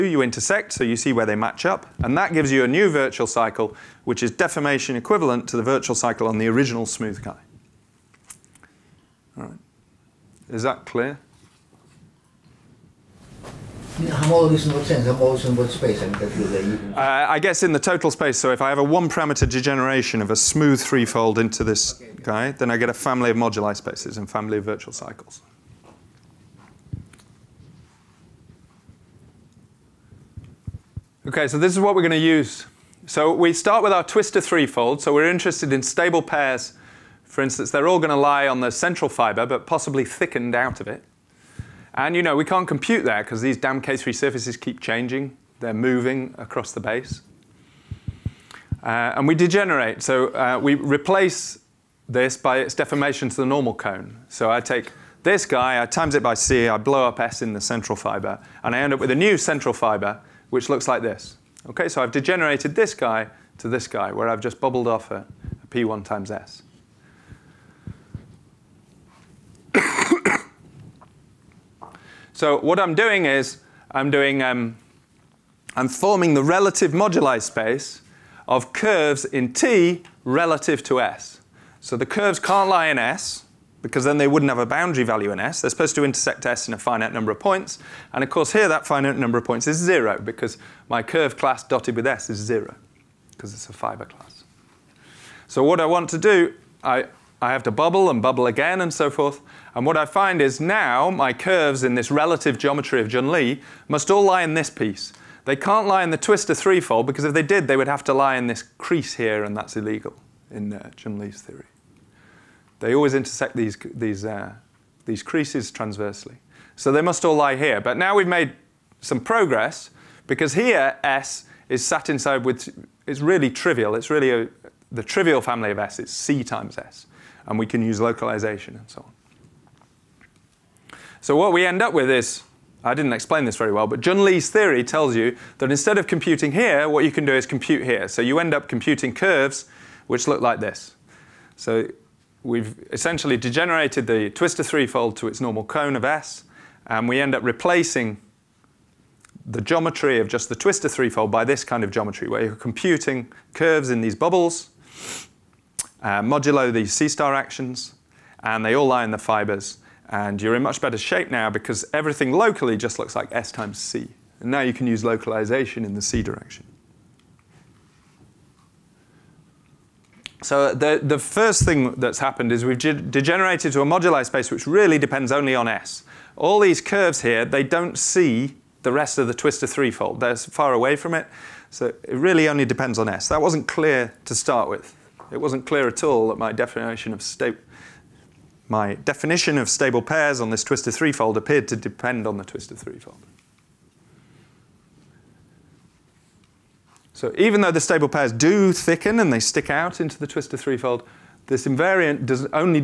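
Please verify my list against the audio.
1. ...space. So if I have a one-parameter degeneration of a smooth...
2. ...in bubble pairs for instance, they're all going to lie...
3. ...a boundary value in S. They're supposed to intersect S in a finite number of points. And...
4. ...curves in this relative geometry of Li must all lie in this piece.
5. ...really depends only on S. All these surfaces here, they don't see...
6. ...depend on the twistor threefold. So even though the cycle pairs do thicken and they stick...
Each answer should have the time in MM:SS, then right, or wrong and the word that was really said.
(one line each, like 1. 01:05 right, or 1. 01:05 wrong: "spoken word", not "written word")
1. 00:18 right
2. 00:35 wrong: "stable", not "bubble"
3. 01:24 right
4. 01:41 right
5. 02:54 wrong: "curves", not "surfaces"
6. 03:11 wrong: "stable", not "cycle".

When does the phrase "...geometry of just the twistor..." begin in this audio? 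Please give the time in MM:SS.
02:29.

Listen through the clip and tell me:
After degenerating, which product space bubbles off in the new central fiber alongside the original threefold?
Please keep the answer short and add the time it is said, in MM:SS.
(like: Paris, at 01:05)
P1 times S, at 01:05.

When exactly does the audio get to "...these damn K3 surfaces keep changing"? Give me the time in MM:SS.
00:43.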